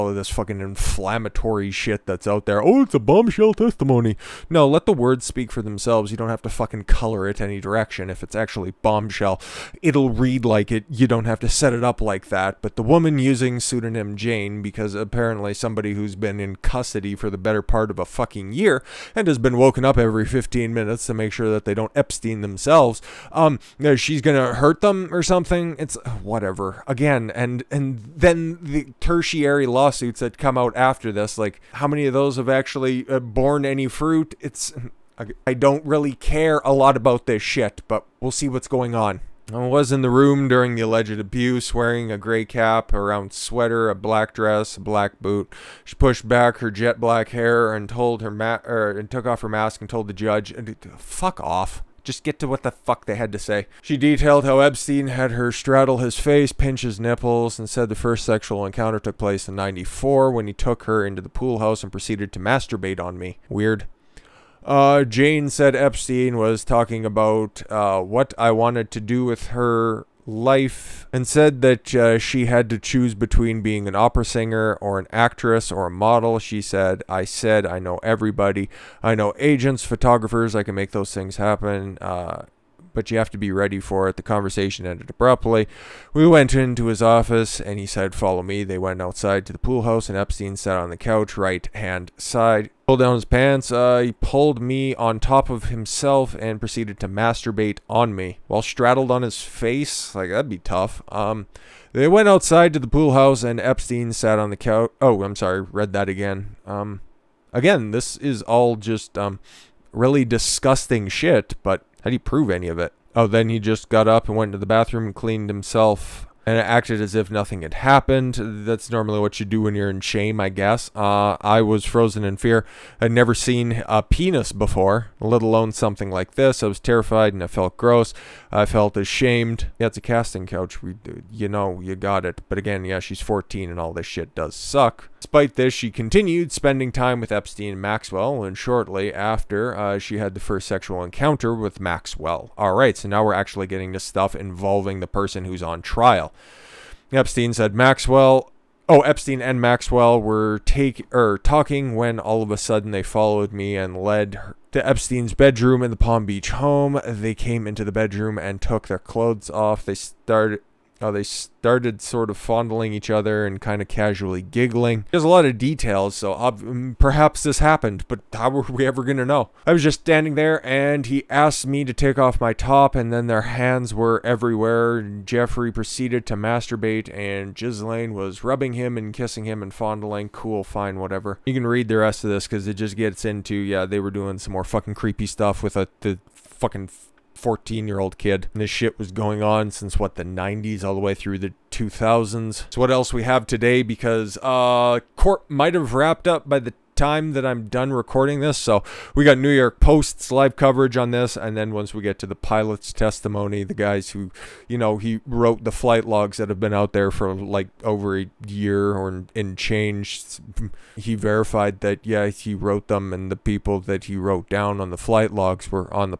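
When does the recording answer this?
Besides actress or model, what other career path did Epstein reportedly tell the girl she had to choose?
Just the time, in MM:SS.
01:13.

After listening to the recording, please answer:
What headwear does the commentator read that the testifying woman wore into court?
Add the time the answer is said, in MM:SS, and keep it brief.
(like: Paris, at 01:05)
gray cap, at 00:42.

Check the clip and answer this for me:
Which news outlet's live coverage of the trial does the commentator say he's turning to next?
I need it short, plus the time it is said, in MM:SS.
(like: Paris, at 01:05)
New York Post, at 03:19.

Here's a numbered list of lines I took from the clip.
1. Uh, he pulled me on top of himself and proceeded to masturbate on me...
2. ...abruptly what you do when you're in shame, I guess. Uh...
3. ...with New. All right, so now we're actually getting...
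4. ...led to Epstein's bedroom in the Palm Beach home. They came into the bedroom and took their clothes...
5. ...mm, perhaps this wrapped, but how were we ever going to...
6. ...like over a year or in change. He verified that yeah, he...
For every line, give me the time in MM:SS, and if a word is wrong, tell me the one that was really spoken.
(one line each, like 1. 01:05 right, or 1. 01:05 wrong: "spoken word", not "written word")
1. 01:33 right
2. 01:58 wrong: "normally", not "abruptly"
3. 02:21 wrong: "Maxwell", not "New"
4. 02:33 right
5. 02:46 wrong: "happened", not "wrapped"
6. 03:27 right.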